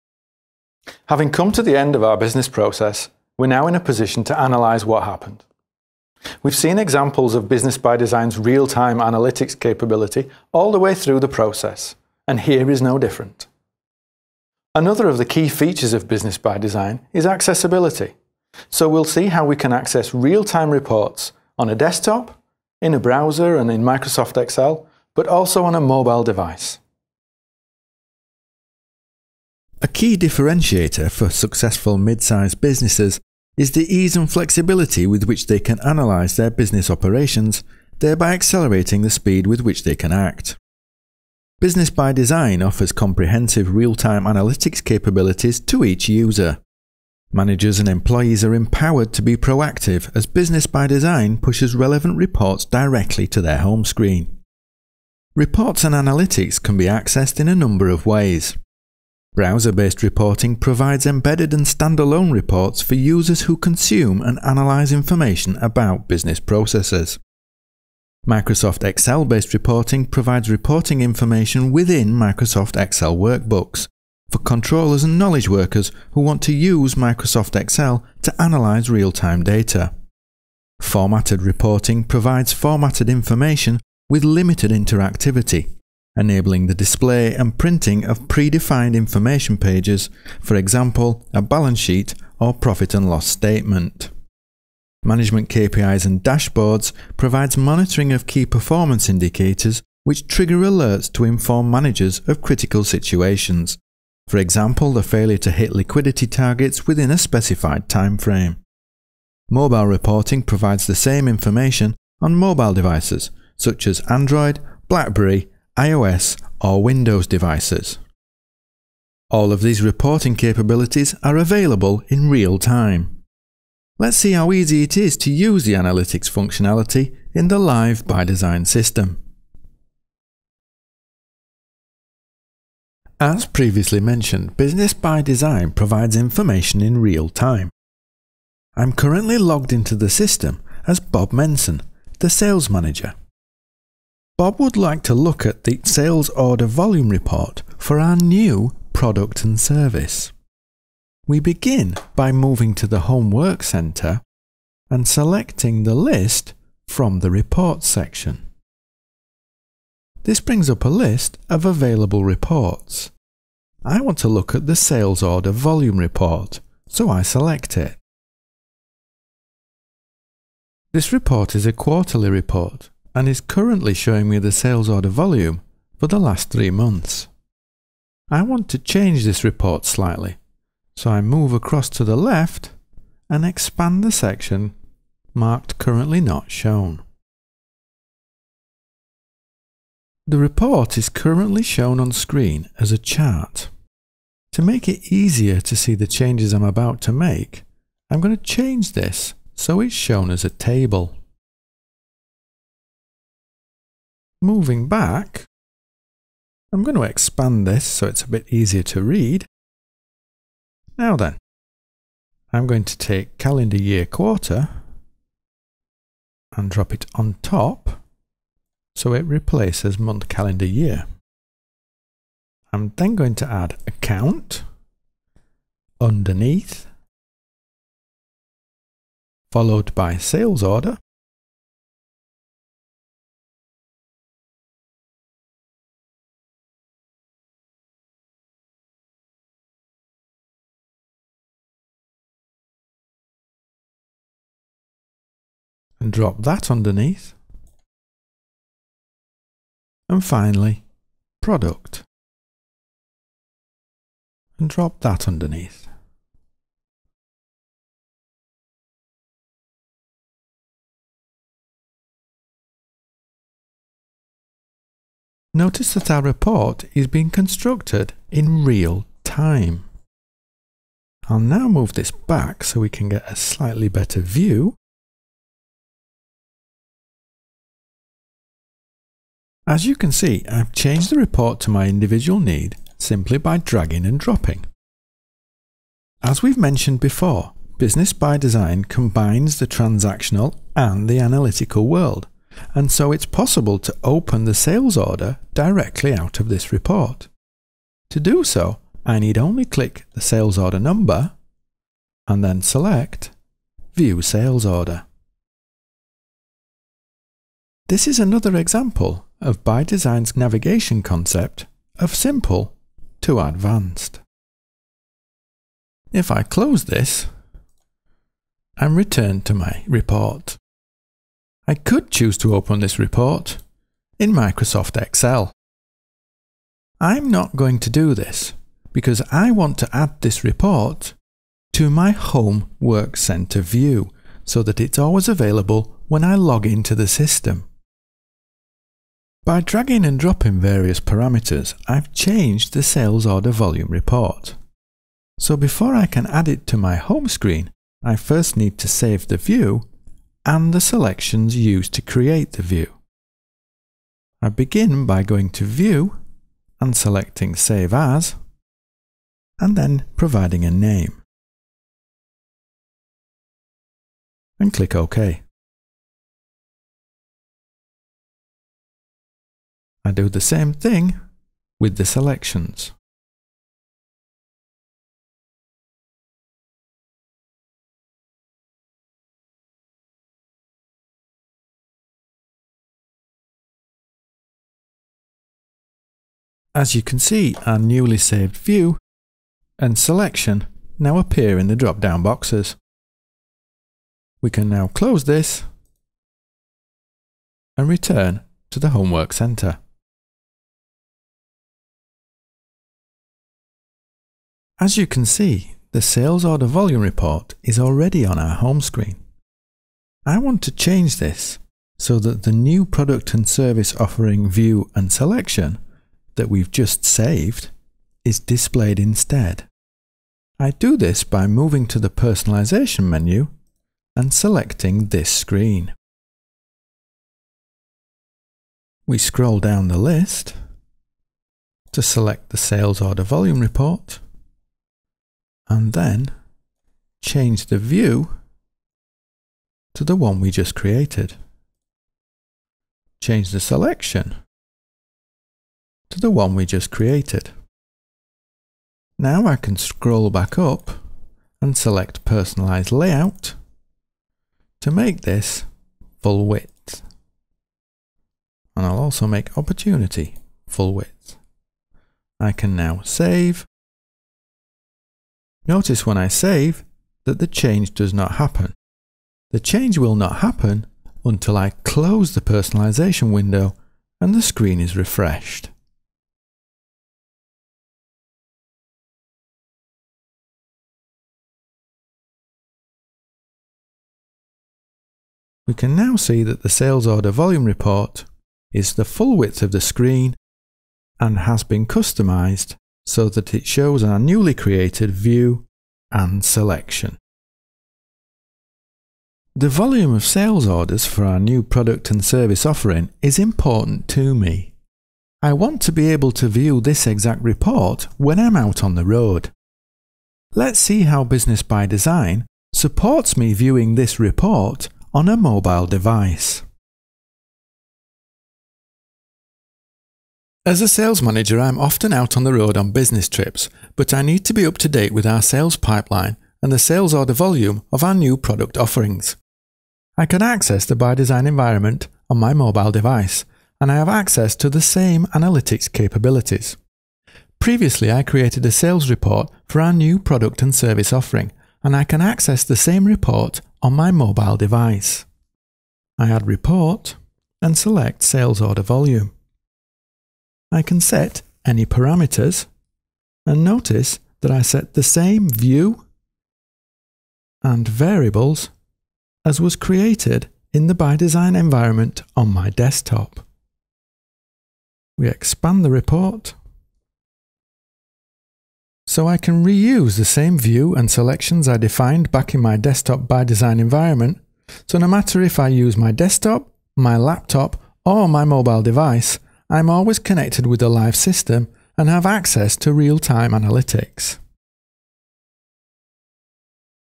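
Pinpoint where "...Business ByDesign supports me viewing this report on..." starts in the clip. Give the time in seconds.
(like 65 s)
511 s.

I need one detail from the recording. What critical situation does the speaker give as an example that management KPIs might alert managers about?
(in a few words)
Liquidity targets.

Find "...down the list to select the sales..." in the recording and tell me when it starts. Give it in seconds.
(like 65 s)
429 s.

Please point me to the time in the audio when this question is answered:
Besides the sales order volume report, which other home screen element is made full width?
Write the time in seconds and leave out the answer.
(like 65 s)
459 s.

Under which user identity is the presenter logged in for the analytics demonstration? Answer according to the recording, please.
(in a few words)
Bob Menson.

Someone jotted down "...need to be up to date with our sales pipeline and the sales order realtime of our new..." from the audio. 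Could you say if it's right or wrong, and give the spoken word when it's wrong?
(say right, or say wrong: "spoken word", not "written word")
wrong: "volume", not "realtime".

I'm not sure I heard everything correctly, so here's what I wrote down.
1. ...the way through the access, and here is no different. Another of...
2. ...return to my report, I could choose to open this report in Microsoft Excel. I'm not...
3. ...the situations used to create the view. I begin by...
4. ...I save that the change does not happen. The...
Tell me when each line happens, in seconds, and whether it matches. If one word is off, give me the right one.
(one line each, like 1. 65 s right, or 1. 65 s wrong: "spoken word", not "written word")
1. 10 s wrong: "process", not "access"
2. 318 s right
3. 350 s wrong: "selections", not "situations"
4. 466 s right.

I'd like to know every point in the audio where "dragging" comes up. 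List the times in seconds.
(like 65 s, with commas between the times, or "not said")
283 s, 339 s.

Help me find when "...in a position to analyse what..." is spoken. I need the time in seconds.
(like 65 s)
3 s.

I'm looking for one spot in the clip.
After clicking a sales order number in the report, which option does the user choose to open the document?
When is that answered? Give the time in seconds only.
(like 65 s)
303 s.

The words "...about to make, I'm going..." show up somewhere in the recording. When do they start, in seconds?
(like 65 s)
196 s.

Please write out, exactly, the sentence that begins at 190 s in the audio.
The report is currently shown on screen as a chart.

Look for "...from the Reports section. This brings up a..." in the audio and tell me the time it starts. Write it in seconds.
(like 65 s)
156 s.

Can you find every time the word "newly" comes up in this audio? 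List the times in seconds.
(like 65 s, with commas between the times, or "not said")
387 s, 494 s.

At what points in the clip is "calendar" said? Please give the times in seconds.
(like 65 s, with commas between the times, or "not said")
213 s, 220 s.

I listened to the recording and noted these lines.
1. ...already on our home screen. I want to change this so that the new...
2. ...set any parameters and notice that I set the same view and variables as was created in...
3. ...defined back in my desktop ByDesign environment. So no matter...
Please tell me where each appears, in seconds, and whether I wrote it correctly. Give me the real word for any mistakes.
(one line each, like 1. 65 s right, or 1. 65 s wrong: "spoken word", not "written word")
1. 407 s right
2. 551 s right
3. 571 s right.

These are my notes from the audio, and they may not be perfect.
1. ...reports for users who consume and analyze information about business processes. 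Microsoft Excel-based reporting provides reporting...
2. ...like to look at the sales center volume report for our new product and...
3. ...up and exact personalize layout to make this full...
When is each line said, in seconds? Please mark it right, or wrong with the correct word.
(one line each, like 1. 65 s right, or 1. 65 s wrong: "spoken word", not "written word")
1. 62 s right
2. 144 s wrong: "order", not "center"
3. 450 s wrong: "select", not "exact".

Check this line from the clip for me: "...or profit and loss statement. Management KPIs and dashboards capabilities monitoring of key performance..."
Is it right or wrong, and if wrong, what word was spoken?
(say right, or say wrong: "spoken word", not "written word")
wrong: "provides", not "capabilities".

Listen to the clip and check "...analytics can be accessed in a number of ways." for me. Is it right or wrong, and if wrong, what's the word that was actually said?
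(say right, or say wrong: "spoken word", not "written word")
right.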